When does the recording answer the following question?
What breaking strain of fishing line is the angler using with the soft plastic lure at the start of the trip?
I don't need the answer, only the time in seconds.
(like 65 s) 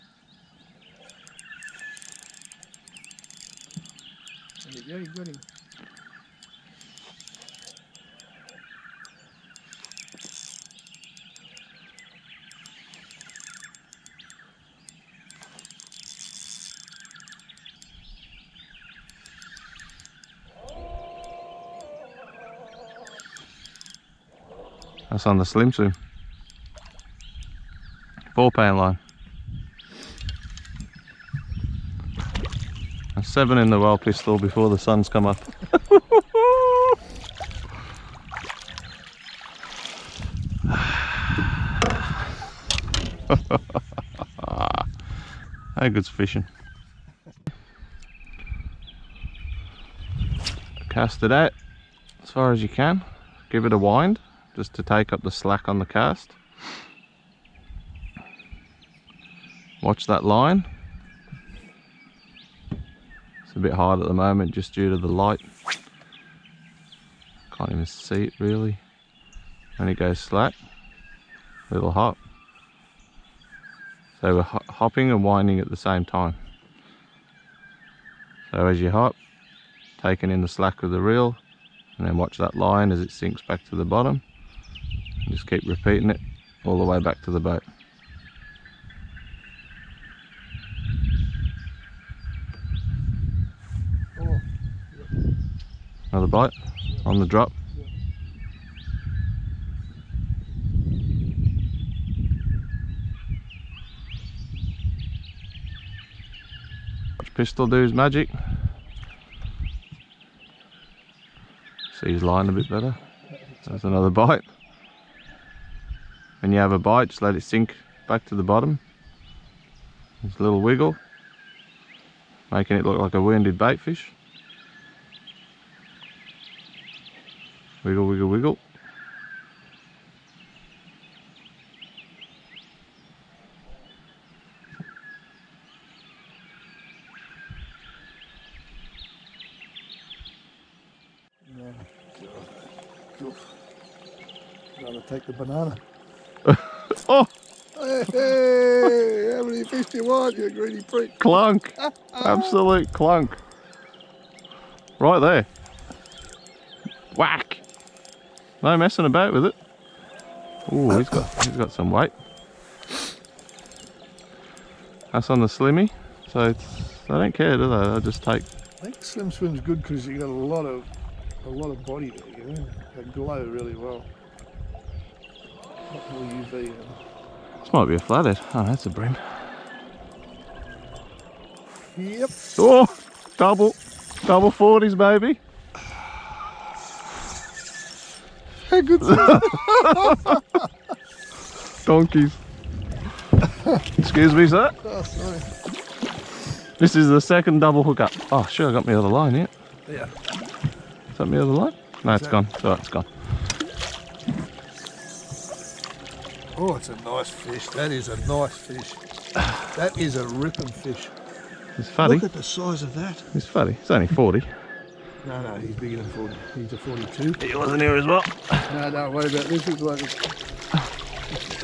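28 s.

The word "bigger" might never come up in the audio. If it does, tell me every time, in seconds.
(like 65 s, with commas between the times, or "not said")
215 s.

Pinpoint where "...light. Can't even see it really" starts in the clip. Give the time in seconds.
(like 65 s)
65 s.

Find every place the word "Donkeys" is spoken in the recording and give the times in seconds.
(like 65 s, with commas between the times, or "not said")
191 s.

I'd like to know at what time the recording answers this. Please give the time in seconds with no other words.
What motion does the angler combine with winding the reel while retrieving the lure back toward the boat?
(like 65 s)
74 s.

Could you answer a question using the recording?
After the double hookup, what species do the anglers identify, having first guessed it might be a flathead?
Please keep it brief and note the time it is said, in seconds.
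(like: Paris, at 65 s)
Bream, at 178 s.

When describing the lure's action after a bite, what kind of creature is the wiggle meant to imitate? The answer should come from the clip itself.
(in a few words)
Wounded bait fish.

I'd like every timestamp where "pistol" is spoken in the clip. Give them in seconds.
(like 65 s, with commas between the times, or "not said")
33 s, 107 s.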